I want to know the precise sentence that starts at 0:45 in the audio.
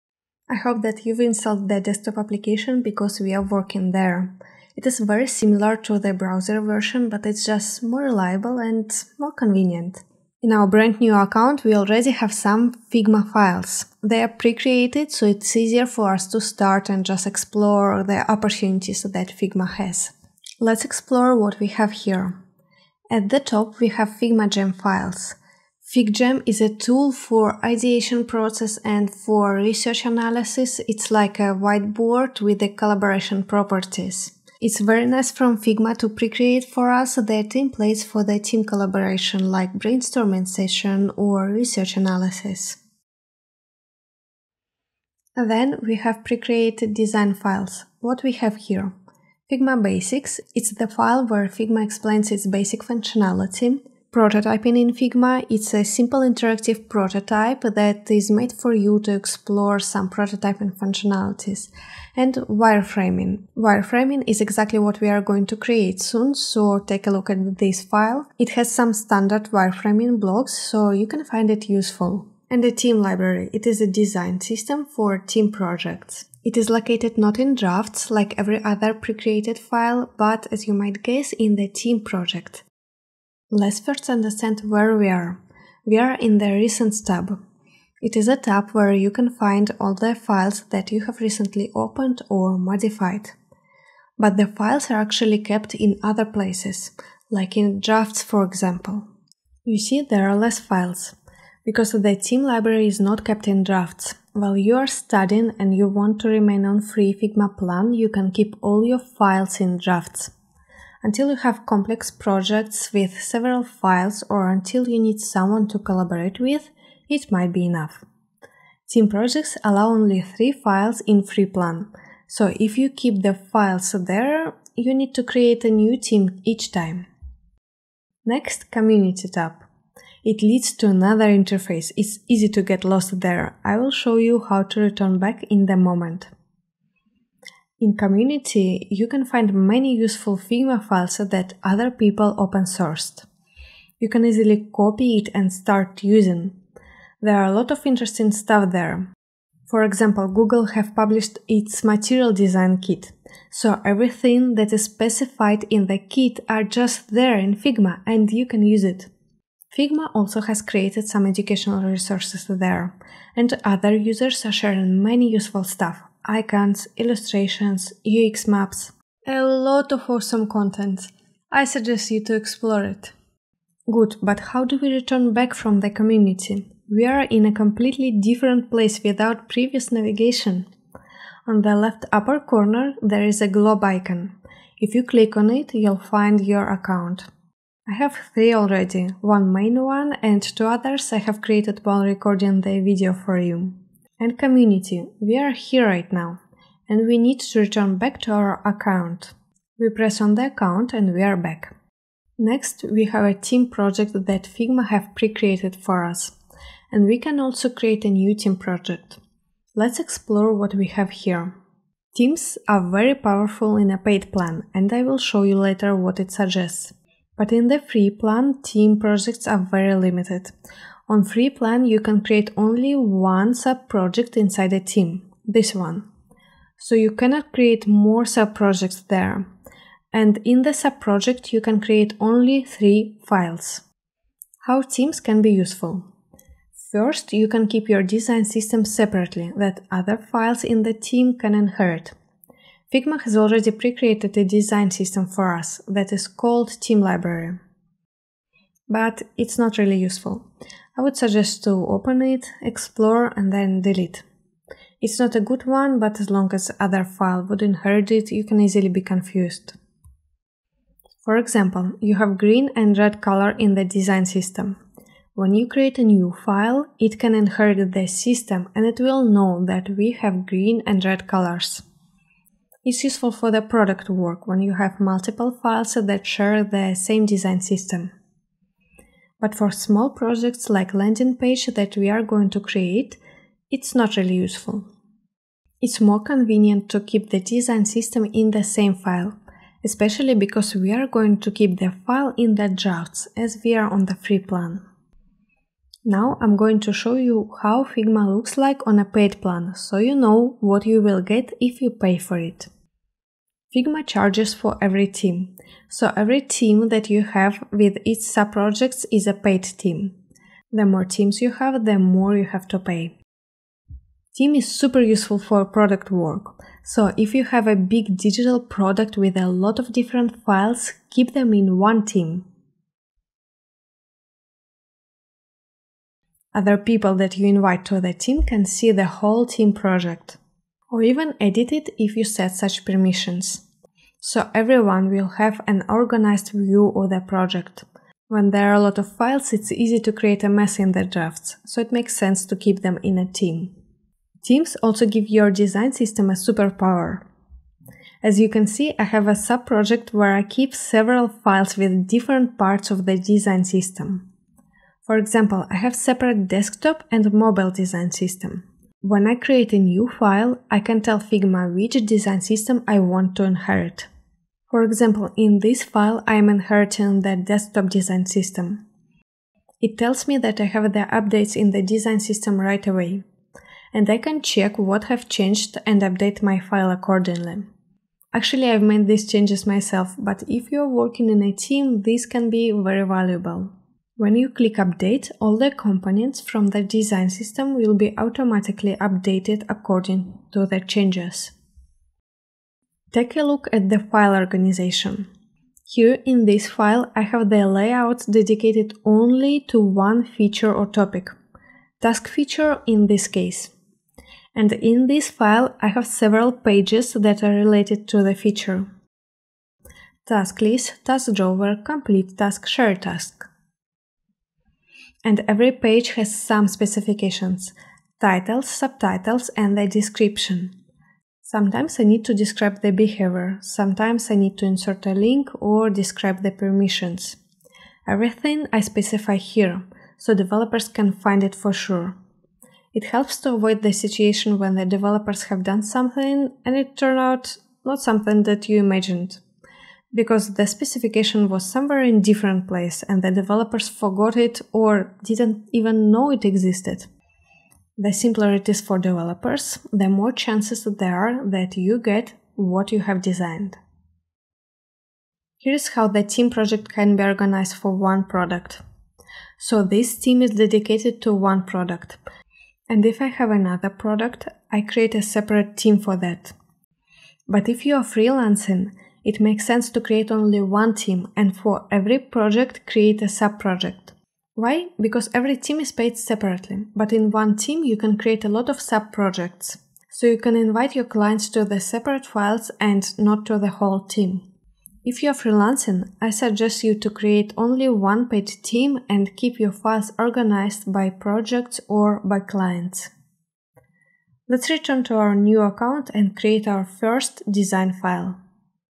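then we have pre-created design files.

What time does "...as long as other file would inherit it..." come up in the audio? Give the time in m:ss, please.
4:16.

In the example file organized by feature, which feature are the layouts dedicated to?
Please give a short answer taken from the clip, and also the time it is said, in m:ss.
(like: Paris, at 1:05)
task feature, at 6:41.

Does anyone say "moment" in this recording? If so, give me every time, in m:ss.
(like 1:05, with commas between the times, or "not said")
2:15.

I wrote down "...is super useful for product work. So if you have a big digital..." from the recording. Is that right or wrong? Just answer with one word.
right.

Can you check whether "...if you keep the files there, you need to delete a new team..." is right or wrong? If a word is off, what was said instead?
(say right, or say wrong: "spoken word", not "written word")
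wrong: "create", not "delete".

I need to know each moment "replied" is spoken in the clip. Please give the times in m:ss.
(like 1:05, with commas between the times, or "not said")
not said.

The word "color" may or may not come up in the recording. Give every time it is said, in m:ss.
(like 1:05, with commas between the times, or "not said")
4:23, 4:31.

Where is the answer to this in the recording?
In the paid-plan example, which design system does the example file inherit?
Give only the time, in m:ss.
6:07.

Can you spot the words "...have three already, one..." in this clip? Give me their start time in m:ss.
3:07.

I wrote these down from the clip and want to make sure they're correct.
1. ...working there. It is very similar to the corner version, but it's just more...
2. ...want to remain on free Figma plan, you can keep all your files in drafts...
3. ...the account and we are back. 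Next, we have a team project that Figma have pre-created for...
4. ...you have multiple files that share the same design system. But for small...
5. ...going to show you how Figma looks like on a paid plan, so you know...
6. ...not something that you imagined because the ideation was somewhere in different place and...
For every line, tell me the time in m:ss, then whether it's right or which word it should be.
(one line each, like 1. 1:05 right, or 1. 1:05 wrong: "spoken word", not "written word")
1. 0:03 wrong: "browser", not "corner"
2. 1:45 right
3. 3:20 right
4. 4:34 right
5. 4:56 right
6. 7:17 wrong: "specification", not "ideation".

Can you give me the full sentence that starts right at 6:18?
Actually, I've made these changes myself, but if you're working in a team, this can be very valuable.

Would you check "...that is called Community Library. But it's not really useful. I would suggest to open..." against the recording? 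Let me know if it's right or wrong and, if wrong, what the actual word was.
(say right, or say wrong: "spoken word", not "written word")
wrong: "Team", not "Community".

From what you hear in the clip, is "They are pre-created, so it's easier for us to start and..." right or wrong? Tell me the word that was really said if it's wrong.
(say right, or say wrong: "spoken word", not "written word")
right.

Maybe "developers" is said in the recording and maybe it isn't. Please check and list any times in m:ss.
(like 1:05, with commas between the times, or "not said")
7:10, 7:14, 7:23, 7:28.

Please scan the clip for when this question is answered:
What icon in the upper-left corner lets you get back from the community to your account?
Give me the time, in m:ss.
3:03.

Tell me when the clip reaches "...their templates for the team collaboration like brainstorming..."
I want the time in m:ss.
0:37.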